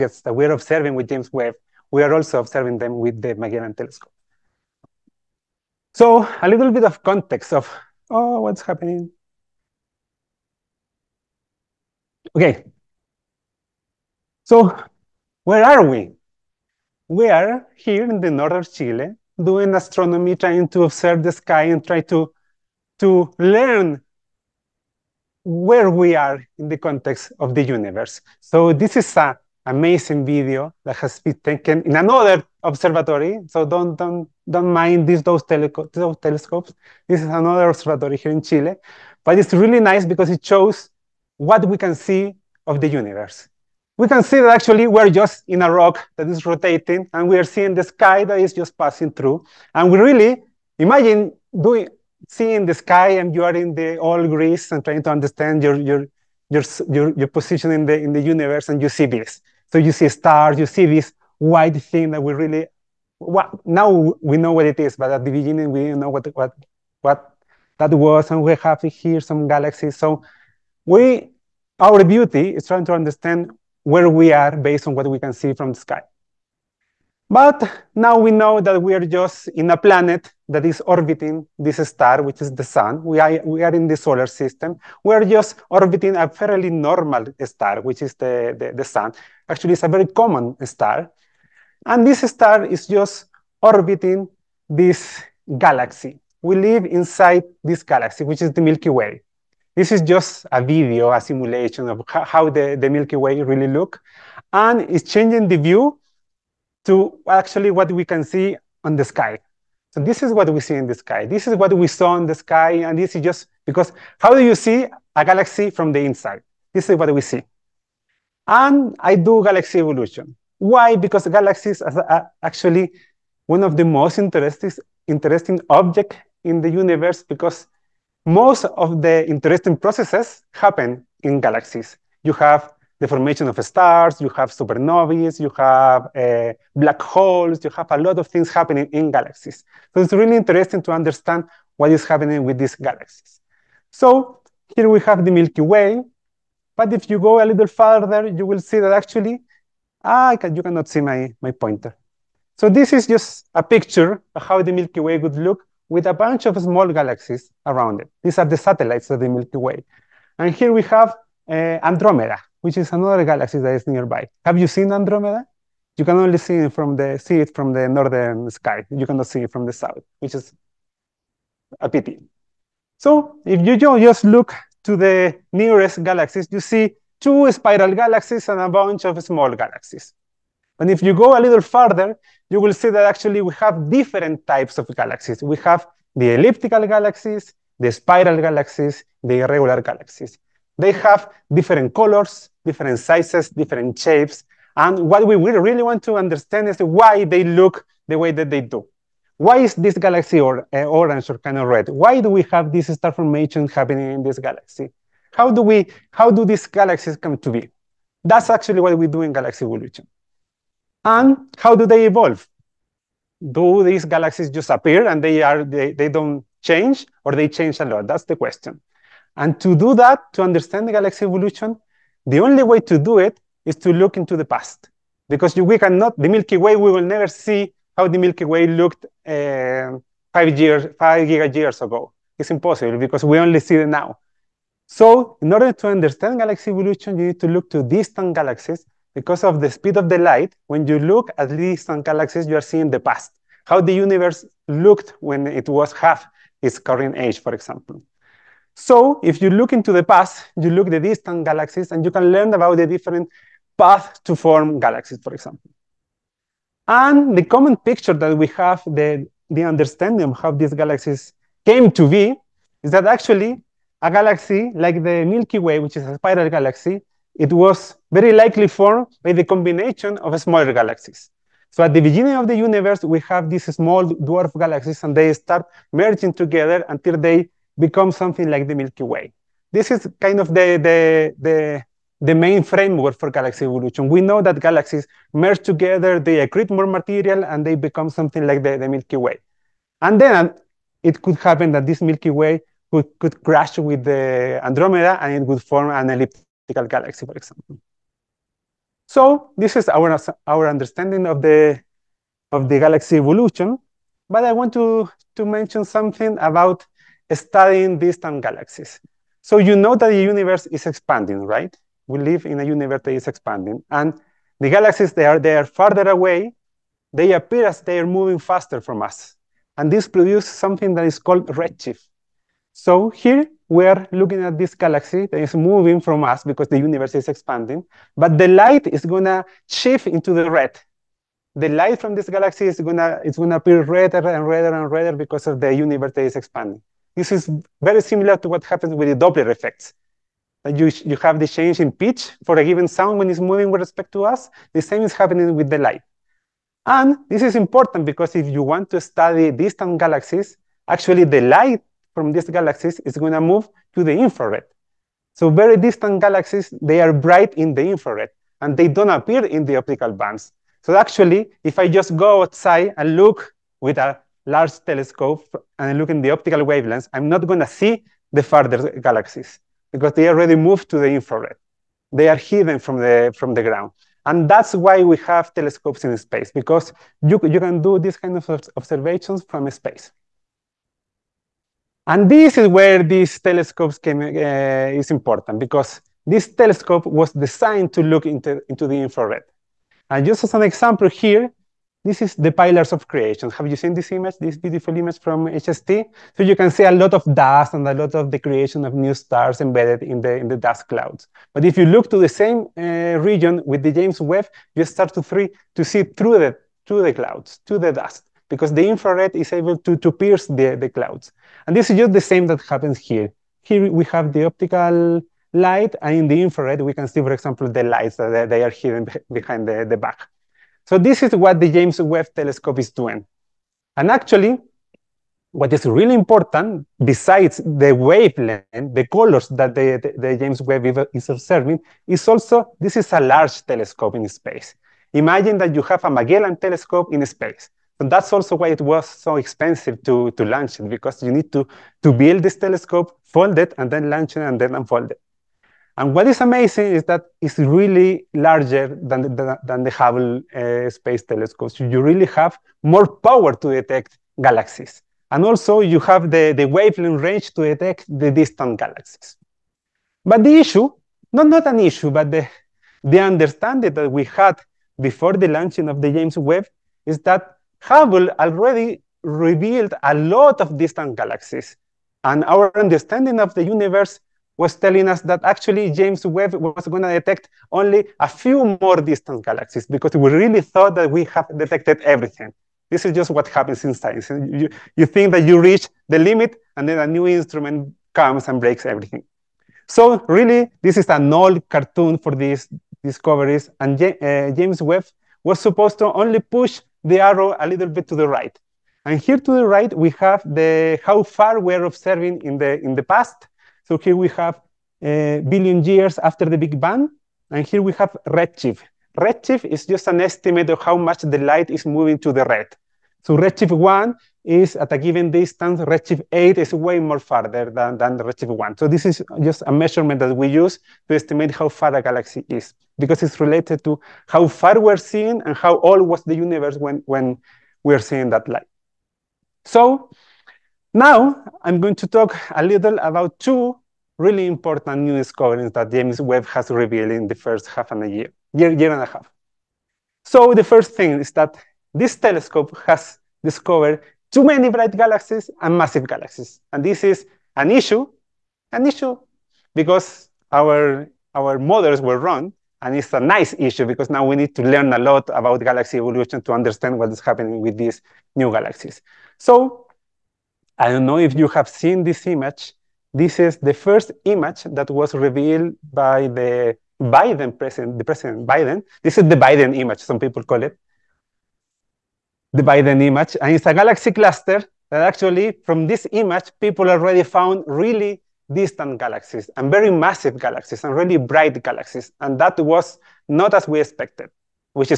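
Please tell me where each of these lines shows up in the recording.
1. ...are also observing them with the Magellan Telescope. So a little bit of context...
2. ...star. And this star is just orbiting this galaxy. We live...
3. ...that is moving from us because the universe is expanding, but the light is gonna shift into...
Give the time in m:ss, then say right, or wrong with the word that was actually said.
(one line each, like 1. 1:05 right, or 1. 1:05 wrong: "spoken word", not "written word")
1. 0:02 right
2. 1:30 right
3. 5:25 right.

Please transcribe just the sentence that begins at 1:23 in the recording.
We are, we are in the solar system.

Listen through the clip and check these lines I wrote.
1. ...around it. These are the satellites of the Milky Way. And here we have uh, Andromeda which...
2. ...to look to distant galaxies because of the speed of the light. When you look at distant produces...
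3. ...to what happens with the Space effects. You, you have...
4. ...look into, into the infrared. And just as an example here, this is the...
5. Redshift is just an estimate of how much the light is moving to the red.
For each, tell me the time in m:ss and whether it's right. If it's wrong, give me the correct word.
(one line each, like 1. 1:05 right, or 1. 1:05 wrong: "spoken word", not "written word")
1. 2:37 right
2. 3:57 wrong: "galaxies", not "produces"
3. 5:38 wrong: "Doppler", not "Space"
4. 6:28 right
5. 8:29 right.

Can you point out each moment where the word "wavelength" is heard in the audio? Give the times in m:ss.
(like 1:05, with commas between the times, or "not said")
6:06, 7:07, 7:36.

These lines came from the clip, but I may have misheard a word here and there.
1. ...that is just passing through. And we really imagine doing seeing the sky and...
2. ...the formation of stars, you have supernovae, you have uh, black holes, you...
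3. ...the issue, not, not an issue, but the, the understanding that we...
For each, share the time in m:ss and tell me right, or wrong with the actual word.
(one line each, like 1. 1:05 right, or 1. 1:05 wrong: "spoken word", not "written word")
1. 0:48 right
2. 2:12 right
3. 7:40 right.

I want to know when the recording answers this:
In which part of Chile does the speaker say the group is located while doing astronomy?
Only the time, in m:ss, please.
0:18.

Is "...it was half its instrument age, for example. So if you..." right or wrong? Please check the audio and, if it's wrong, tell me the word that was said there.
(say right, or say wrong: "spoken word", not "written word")
wrong: "current", not "instrument".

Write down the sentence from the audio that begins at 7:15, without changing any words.
Imagine that you have a Magellan telescope in space.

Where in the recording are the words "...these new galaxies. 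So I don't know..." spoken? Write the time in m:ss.
9:17.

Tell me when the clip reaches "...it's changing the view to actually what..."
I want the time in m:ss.
1:44.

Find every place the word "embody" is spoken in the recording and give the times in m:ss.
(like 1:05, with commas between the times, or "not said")
not said.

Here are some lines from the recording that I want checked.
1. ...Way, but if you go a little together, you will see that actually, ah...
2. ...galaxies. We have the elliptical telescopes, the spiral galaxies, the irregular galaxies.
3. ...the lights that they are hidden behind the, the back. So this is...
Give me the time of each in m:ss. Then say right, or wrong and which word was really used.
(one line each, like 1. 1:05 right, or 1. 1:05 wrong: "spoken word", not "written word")
1. 2:25 wrong: "further", not "together"
2. 3:04 wrong: "galaxies", not "telescopes"
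3. 6:57 right.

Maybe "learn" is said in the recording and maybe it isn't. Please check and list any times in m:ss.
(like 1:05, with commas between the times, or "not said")
0:23, 4:12, 9:14.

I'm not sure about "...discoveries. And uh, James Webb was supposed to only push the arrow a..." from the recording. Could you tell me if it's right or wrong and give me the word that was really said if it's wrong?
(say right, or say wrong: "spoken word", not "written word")
right.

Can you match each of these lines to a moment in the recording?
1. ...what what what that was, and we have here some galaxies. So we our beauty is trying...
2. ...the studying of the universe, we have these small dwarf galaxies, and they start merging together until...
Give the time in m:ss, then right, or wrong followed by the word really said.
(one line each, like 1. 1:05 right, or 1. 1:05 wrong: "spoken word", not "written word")
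1. 1:06 right
2. 4:31 wrong: "beginning", not "studying".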